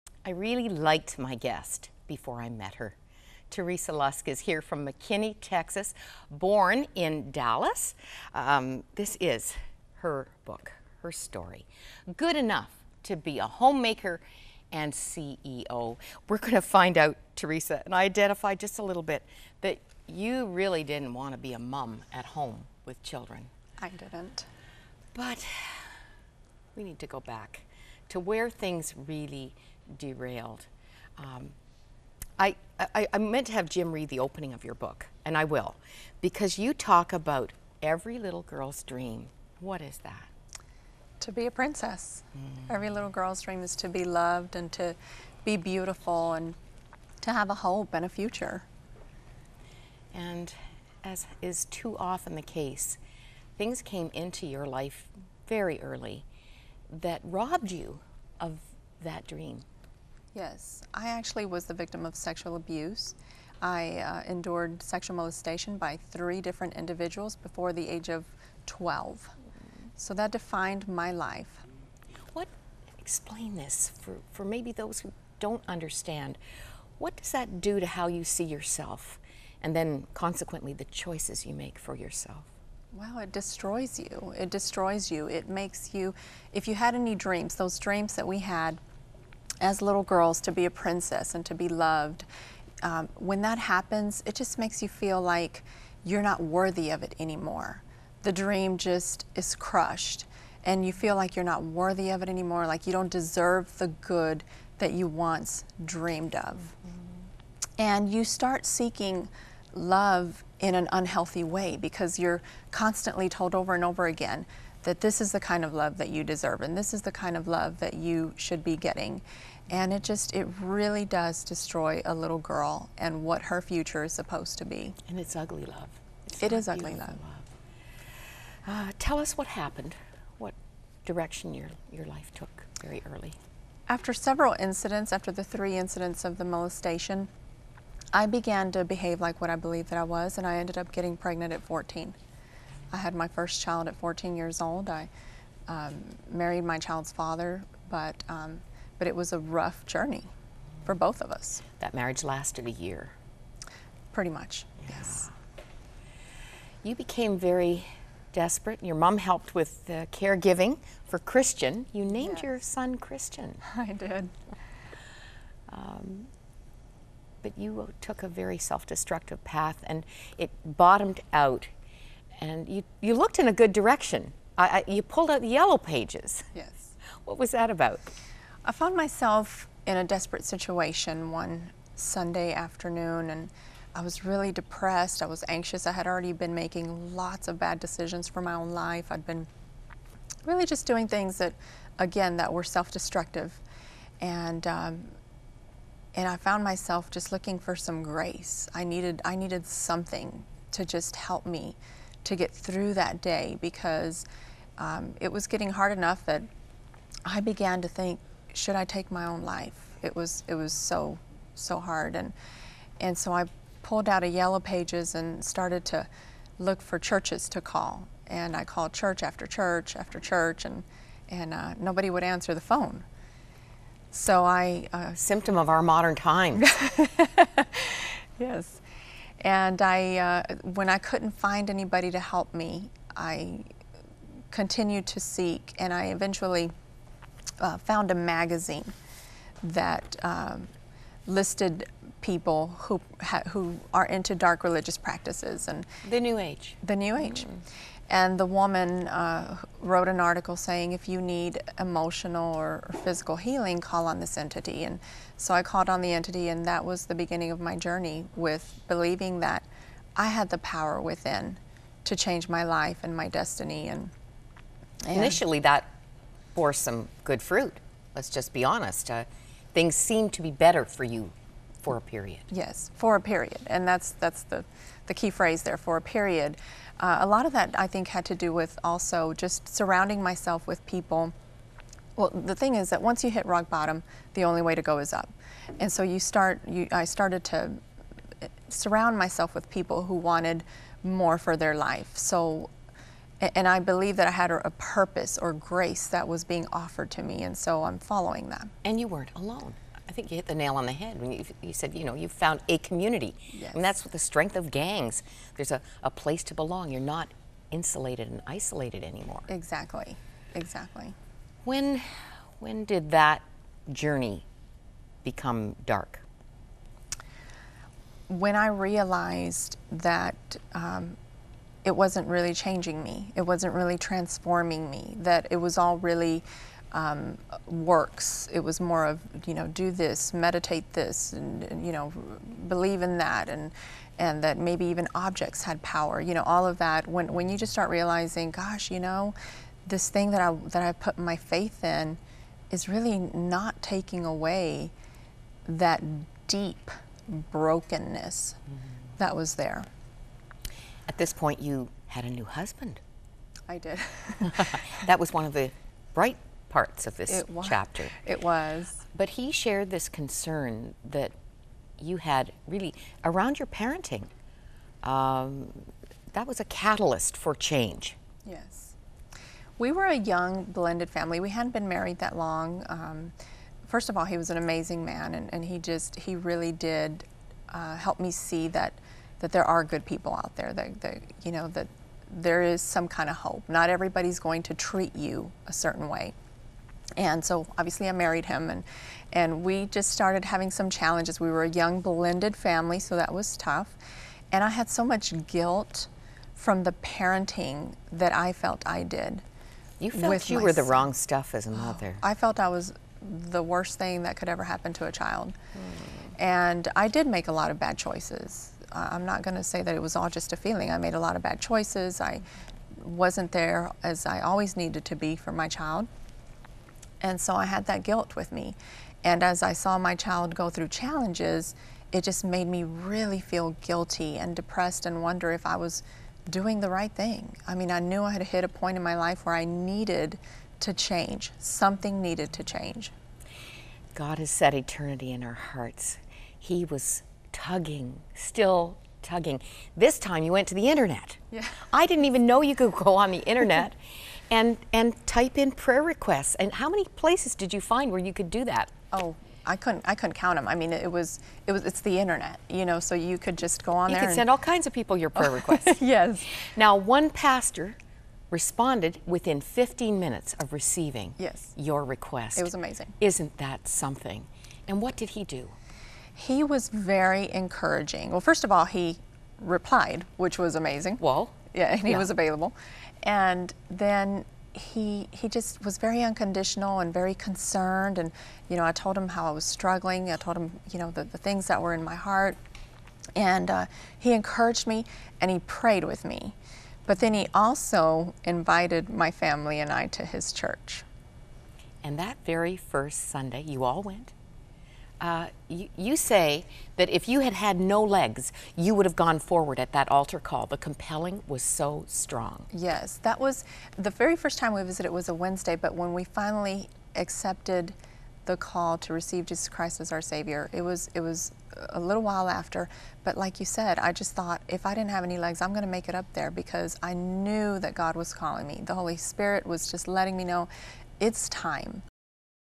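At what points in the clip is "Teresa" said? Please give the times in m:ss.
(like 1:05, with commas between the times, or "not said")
0:03, 0:17.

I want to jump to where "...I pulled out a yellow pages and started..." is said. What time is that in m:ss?
3:33.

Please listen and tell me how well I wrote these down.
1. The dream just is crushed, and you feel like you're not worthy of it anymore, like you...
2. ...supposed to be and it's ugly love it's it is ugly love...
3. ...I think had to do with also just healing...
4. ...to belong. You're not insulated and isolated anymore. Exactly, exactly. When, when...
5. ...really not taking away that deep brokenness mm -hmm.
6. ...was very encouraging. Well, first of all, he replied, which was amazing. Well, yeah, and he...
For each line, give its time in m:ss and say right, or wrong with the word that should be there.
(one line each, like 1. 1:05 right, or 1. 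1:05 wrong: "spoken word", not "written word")
1. 1:38 right
2. 2:04 right
3. 4:37 wrong: "surrounding", not "healing"
4. 5:06 right
5. 5:42 right
6. 7:46 right.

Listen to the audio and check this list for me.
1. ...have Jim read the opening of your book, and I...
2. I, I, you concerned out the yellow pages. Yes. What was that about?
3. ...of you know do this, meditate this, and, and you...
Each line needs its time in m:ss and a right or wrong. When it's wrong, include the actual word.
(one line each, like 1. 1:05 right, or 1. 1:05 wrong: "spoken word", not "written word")
1. 0:33 right
2. 2:54 wrong: "pulled", not "concerned"
3. 5:29 right.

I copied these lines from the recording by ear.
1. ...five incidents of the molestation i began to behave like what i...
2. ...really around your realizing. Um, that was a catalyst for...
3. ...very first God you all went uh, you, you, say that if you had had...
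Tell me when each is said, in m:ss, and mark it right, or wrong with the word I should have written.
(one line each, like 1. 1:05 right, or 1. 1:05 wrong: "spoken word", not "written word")
1. 2:15 wrong: "three", not "five"
2. 6:02 wrong: "parenting", not "realizing"
3. 8:12 wrong: "Sunday", not "God".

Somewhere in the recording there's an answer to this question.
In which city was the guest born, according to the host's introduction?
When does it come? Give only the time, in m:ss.
0:07.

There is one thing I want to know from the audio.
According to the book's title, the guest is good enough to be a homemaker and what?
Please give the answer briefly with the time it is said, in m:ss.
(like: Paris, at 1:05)
CEO, at 0:14.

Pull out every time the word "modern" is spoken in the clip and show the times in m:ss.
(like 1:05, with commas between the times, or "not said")
3:45.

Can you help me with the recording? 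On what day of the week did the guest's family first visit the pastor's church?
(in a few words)
Wednesday.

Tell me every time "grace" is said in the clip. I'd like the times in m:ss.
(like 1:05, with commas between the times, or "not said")
3:18, 4:55.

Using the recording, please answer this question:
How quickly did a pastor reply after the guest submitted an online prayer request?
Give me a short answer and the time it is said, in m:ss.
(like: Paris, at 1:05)
15 minutes, at 7:39.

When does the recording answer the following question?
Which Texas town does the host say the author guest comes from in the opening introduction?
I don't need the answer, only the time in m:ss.
0:04.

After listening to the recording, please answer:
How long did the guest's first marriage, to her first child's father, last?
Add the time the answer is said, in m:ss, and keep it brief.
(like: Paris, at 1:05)
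A year, at 2:32.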